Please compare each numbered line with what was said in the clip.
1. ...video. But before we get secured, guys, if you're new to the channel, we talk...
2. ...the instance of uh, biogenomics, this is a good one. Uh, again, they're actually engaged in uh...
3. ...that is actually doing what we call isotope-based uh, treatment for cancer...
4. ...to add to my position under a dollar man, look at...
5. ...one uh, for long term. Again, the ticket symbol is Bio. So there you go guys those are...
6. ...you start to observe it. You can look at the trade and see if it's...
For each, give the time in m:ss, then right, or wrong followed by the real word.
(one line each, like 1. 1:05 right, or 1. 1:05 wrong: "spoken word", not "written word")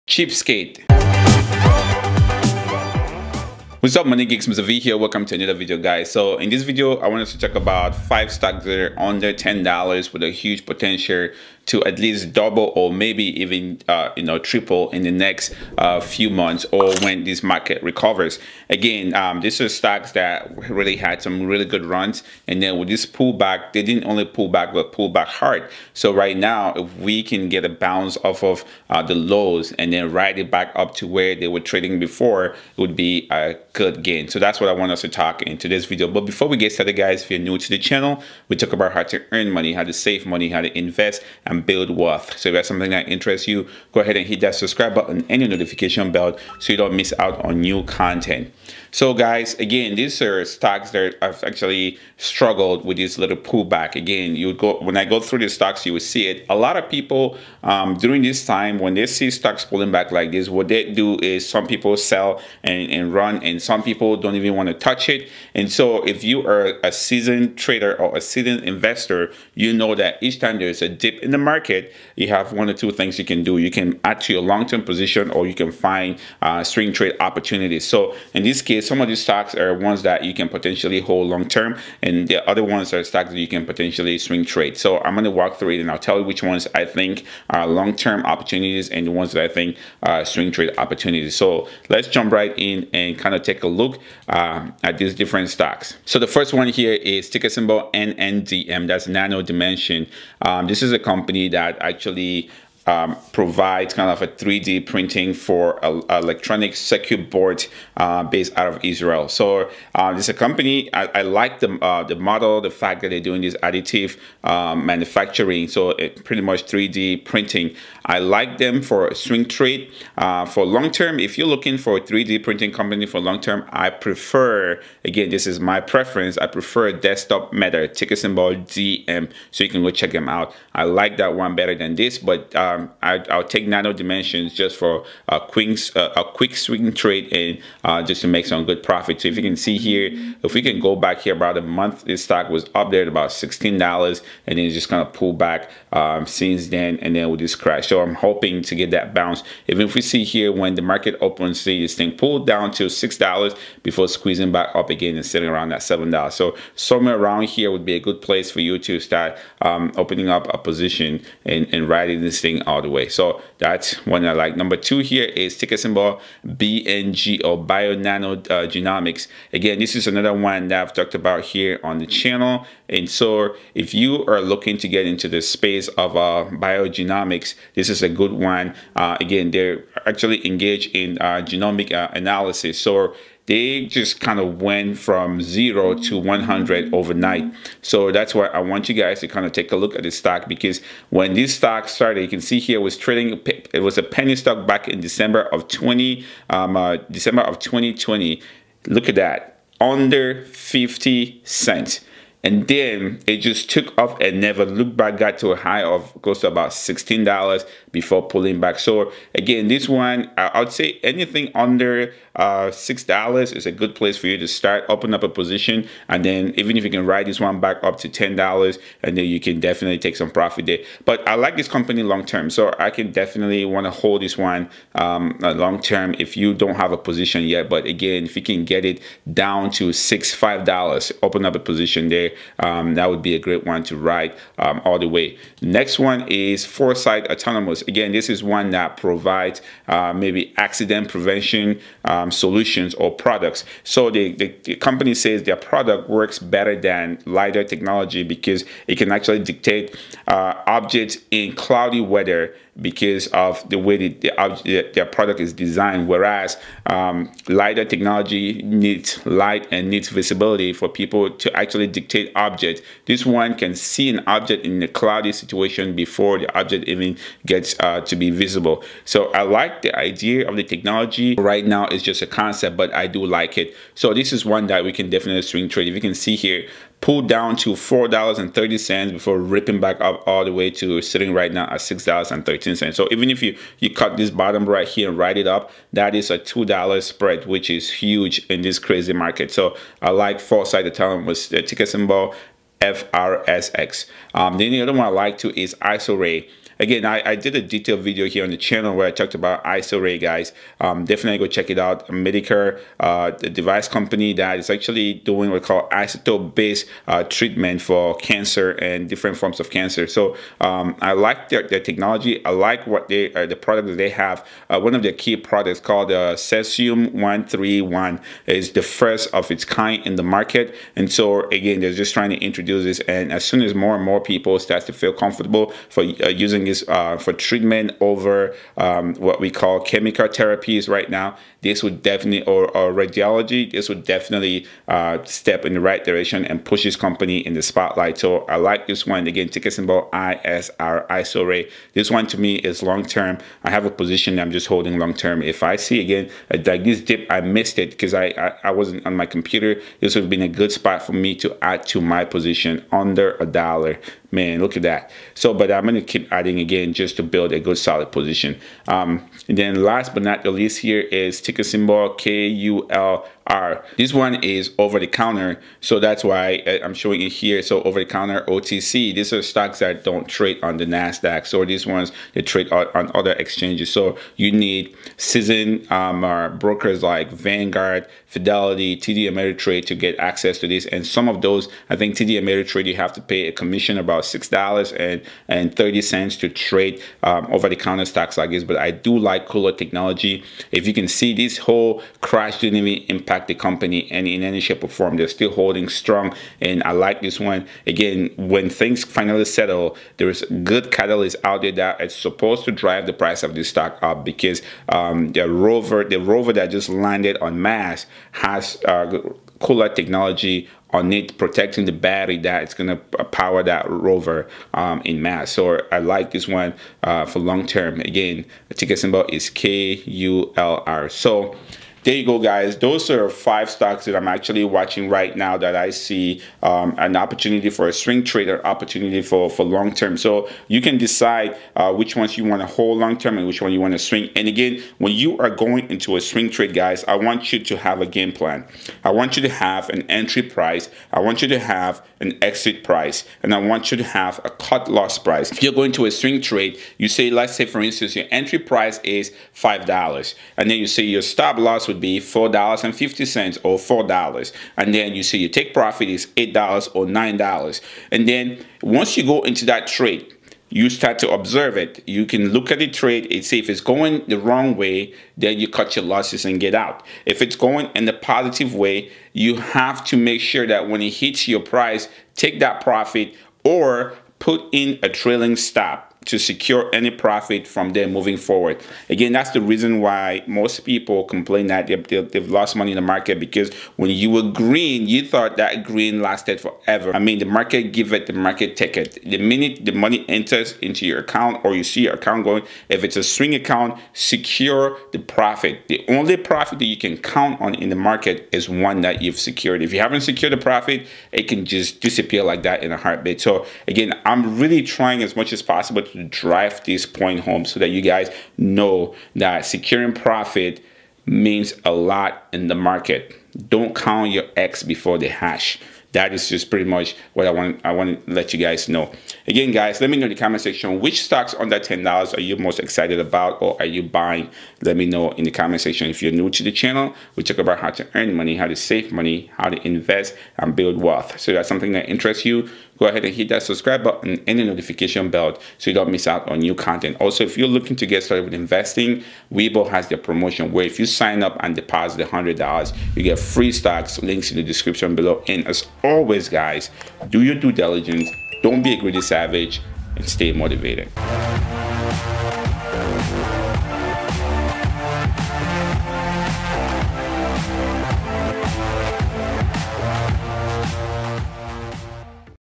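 1. 0:35 wrong: "started", not "secured"
2. 2:55 wrong: "space", not "instance"
3. 5:04 right
4. 5:51 right
5. 6:56 wrong: "KULR", not "Bio"
6. 7:40 right.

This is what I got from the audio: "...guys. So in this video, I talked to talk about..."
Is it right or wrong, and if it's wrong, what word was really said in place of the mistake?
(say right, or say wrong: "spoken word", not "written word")
wrong: "wanted", not "talked".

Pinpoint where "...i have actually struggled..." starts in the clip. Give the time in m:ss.
0:51.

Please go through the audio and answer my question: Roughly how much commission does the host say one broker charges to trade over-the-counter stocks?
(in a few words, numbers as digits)
$6.30.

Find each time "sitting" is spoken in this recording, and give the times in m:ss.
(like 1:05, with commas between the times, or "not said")
2:35, 4:41.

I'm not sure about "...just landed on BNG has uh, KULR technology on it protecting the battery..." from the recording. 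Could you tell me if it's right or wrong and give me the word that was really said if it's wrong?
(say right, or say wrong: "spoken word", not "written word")
wrong: "Mars", not "BNG".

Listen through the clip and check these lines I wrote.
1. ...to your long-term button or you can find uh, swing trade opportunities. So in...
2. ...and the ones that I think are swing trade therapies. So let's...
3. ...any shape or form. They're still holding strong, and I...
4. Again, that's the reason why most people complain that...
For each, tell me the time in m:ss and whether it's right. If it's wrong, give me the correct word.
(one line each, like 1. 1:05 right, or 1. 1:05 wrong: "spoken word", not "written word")
1. 1:14 wrong: "position", not "button"
2. 1:28 wrong: "opportunities", not "therapies"
3. 6:34 right
4. 7:59 right.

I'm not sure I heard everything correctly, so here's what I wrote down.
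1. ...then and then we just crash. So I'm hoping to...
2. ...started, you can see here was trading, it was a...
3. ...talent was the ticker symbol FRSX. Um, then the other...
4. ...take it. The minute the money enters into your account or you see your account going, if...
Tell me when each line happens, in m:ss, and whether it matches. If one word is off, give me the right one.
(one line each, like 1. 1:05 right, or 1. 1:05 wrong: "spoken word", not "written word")
1. 2:26 right
2. 3:11 right
3. 4:50 right
4. 8:08 right.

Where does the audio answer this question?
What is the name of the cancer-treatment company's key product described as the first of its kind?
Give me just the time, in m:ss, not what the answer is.
5:16.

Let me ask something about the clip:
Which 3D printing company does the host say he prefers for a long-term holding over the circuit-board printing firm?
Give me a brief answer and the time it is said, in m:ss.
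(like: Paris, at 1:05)
Desktop Metal, at 2:06.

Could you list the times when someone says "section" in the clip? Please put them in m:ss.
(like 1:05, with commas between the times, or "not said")
8:40, 8:45.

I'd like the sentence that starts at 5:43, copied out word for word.
I have a position I'm just holding long-term.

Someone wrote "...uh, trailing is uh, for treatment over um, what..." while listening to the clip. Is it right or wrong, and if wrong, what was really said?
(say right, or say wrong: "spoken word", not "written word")
wrong: "using", not "trailing".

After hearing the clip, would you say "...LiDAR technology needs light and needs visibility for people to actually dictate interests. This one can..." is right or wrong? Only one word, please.
wrong.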